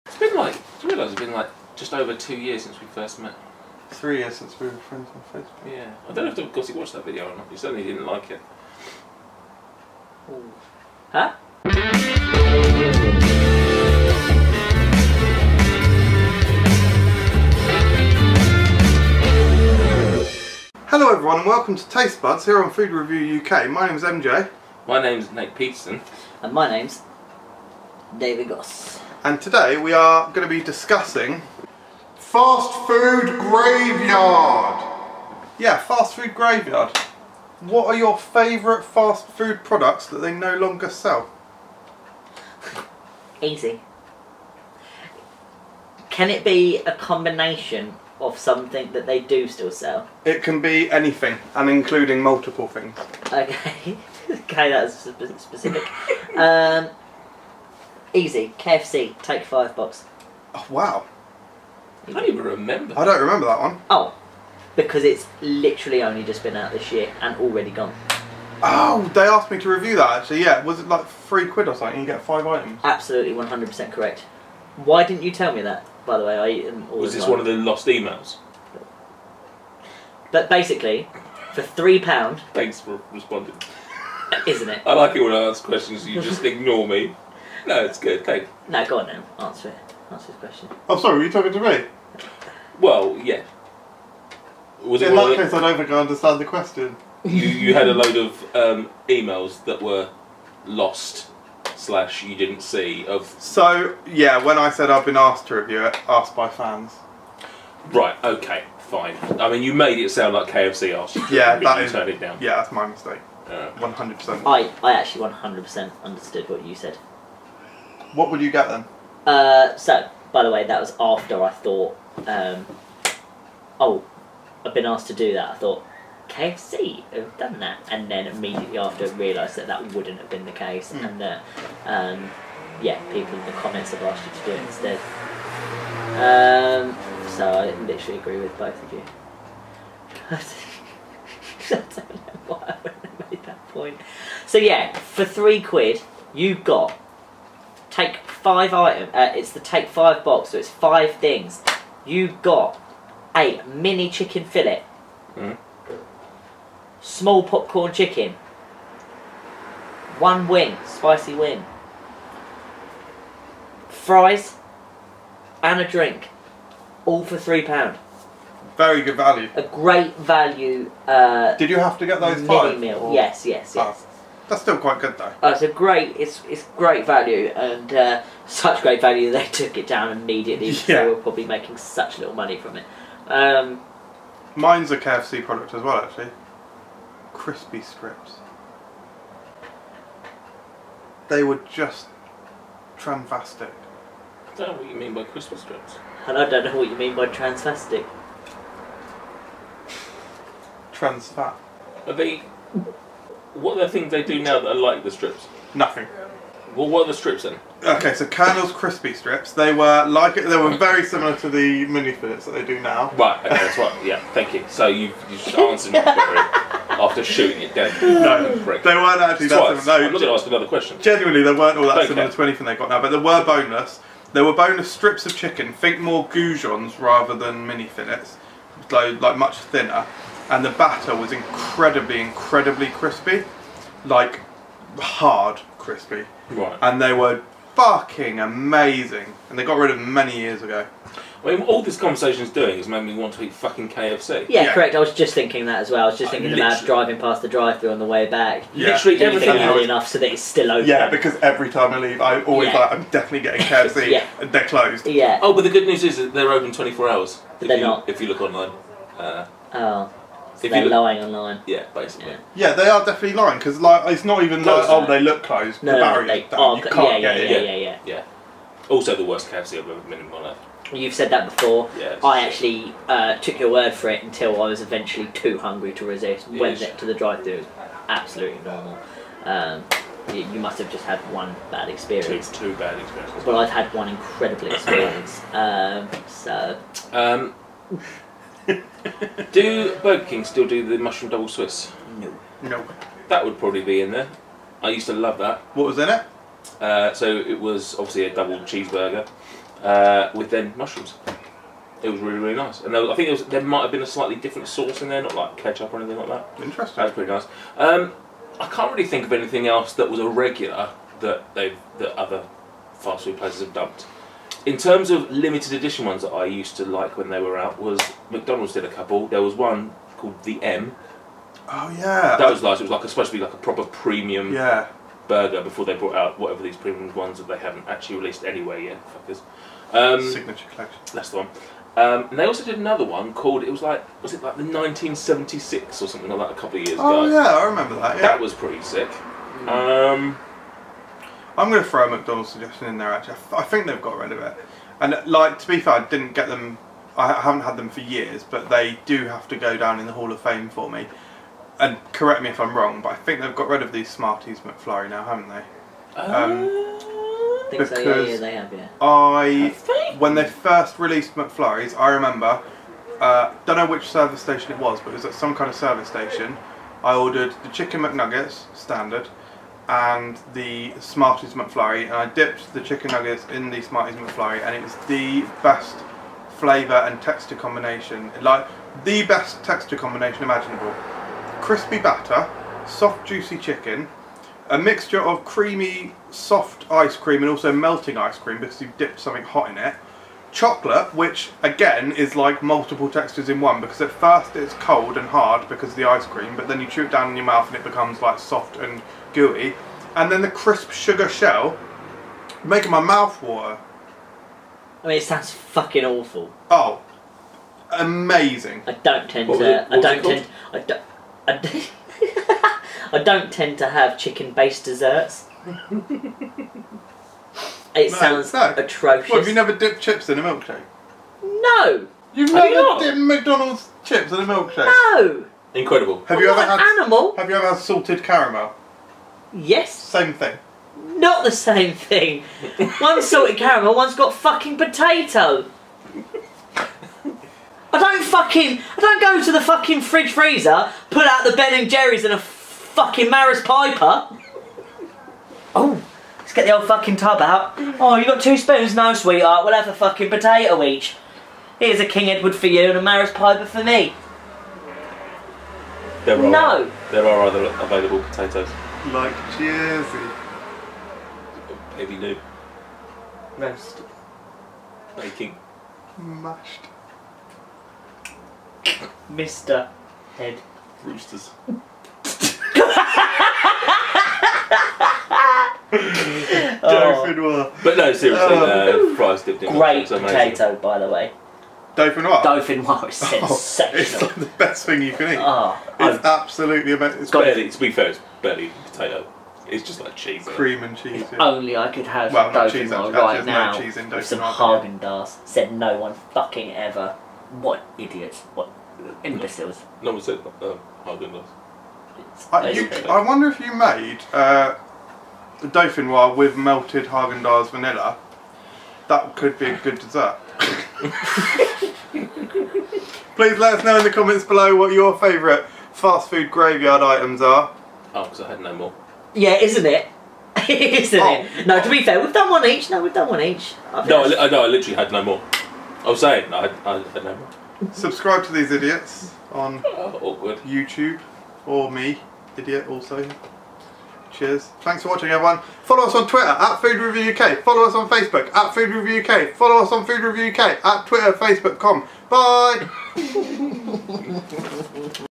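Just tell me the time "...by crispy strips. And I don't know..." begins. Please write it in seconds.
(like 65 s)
195 s.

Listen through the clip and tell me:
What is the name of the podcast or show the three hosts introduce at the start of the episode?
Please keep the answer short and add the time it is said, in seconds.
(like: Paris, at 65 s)
Taste Buds, at 21 s.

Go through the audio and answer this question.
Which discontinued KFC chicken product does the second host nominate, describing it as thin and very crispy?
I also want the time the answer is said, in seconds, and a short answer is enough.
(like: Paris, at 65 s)
Colonel's crispy strips, at 208 s.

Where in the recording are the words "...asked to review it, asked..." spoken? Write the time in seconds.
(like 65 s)
105 s.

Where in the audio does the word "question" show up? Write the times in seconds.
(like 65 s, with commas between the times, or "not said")
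85 s, 90 s, 96 s, 220 s.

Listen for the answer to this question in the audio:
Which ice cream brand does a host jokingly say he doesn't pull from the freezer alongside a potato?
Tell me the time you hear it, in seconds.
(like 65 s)
441 s.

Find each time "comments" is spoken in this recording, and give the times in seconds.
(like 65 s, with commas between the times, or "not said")
133 s, 514 s.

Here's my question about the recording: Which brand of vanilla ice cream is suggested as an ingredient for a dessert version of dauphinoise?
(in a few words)
Haagen-Dazs.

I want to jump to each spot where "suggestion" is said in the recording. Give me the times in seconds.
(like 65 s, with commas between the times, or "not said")
342 s.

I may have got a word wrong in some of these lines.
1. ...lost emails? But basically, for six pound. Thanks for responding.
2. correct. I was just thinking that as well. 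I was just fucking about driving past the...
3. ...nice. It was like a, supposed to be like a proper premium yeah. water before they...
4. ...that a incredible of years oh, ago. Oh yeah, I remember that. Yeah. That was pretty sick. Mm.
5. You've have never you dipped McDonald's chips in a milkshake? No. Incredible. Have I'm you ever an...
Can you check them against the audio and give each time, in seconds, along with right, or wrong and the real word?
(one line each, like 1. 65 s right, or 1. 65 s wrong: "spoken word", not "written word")
1. 77 s wrong: "three", not "six"
2. 244 s wrong: "thinking", not "fucking"
3. 322 s wrong: "burger", not "water"
4. 336 s wrong: "couple", not "incredible"
5. 422 s right.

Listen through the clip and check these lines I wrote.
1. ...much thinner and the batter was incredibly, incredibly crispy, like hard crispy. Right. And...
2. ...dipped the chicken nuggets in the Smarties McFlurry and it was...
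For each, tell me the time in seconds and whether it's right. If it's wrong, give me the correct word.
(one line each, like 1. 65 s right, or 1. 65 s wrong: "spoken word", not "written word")
1. 229 s right
2. 372 s right.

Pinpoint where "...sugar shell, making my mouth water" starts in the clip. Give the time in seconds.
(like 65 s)
400 s.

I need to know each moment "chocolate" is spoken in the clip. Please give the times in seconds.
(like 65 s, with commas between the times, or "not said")
390 s.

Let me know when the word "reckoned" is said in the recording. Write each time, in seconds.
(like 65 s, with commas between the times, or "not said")
not said.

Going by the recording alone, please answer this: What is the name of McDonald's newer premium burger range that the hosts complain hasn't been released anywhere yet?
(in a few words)
Signature collection.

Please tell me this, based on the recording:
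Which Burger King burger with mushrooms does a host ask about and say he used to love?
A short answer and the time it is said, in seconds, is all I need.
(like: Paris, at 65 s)
mushroom double Swiss, at 290 s.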